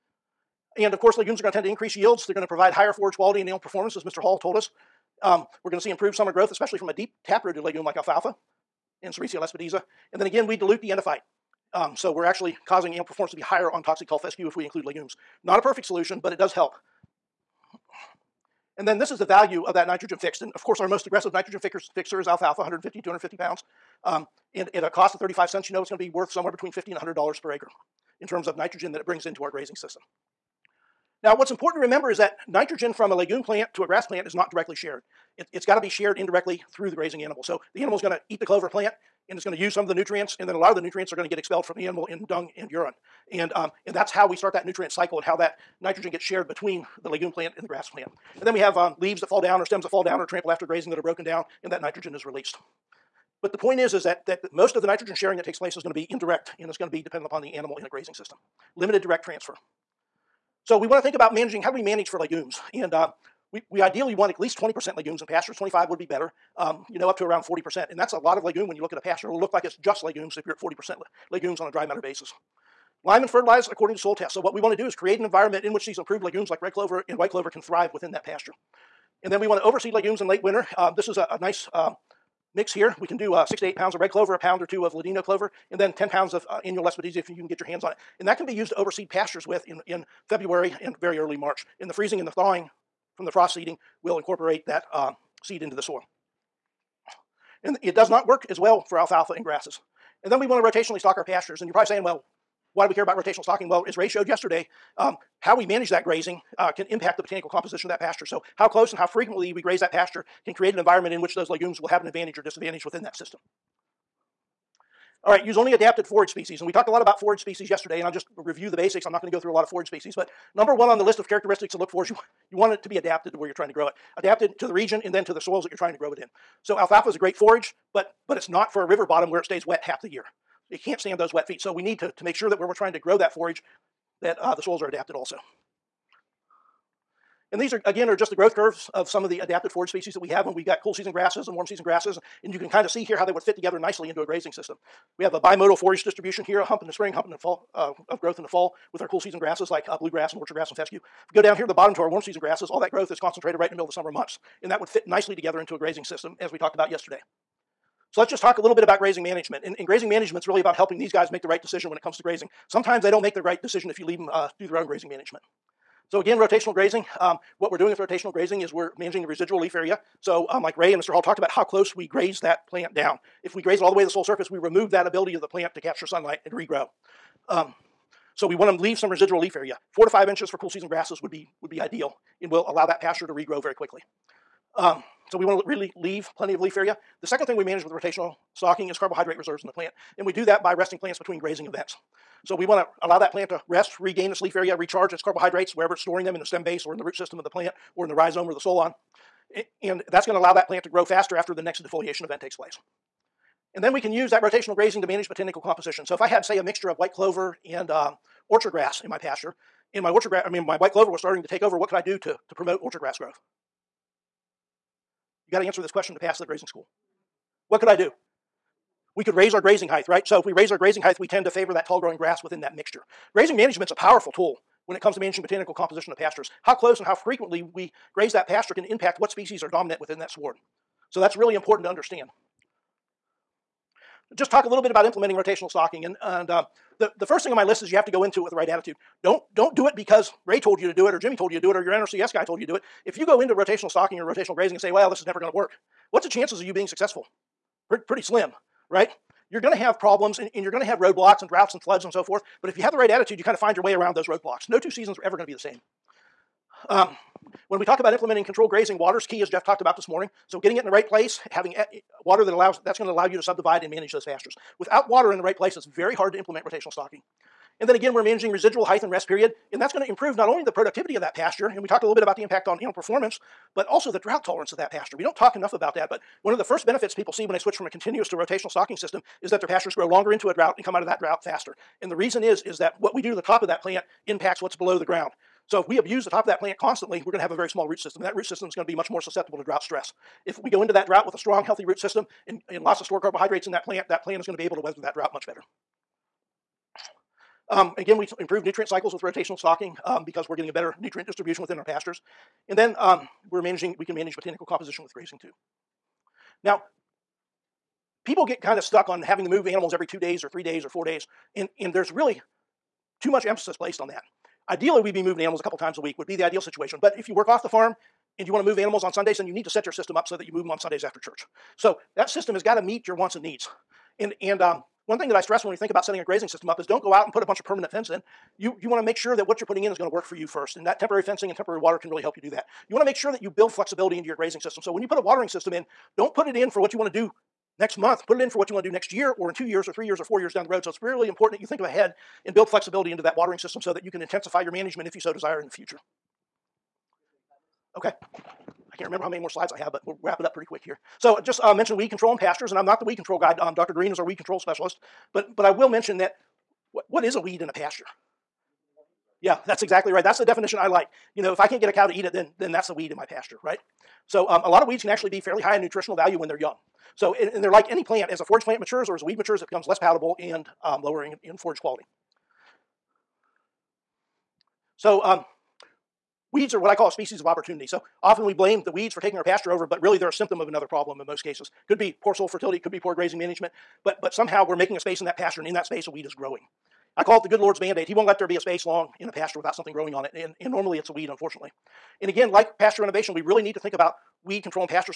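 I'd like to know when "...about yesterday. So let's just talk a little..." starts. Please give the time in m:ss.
2:36.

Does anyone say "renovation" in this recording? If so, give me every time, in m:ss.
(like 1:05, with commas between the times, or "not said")
6:33.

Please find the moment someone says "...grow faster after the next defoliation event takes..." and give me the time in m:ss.
3:20.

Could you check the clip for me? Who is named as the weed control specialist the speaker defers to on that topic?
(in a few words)
Dr. Green.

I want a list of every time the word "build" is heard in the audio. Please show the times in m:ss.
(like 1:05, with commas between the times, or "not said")
5:33, 5:42.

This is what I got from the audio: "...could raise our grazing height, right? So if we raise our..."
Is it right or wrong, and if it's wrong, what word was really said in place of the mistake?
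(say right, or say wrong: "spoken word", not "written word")
right.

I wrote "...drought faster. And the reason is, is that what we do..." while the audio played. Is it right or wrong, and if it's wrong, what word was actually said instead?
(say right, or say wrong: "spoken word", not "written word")
right.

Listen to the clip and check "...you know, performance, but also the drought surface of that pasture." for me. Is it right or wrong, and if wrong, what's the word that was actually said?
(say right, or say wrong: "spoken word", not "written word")
wrong: "tolerance", not "surface".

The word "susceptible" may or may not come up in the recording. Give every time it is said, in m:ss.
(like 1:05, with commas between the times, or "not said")
4:49.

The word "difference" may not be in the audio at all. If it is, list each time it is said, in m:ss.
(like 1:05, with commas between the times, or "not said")
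not said.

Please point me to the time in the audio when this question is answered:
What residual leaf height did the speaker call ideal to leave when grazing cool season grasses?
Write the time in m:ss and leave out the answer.
2:59.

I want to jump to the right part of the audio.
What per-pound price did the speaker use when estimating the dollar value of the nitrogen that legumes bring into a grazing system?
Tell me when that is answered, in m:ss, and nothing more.
0:25.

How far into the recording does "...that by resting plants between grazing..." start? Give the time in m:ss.
3:10.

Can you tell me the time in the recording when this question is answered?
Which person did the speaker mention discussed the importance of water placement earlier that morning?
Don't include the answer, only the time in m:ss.
4:19.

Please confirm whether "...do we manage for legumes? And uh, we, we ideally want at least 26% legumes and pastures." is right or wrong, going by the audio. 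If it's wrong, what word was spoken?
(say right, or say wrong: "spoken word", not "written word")
wrong: "20", not "26".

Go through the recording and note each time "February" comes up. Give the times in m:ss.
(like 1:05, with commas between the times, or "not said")
1:30.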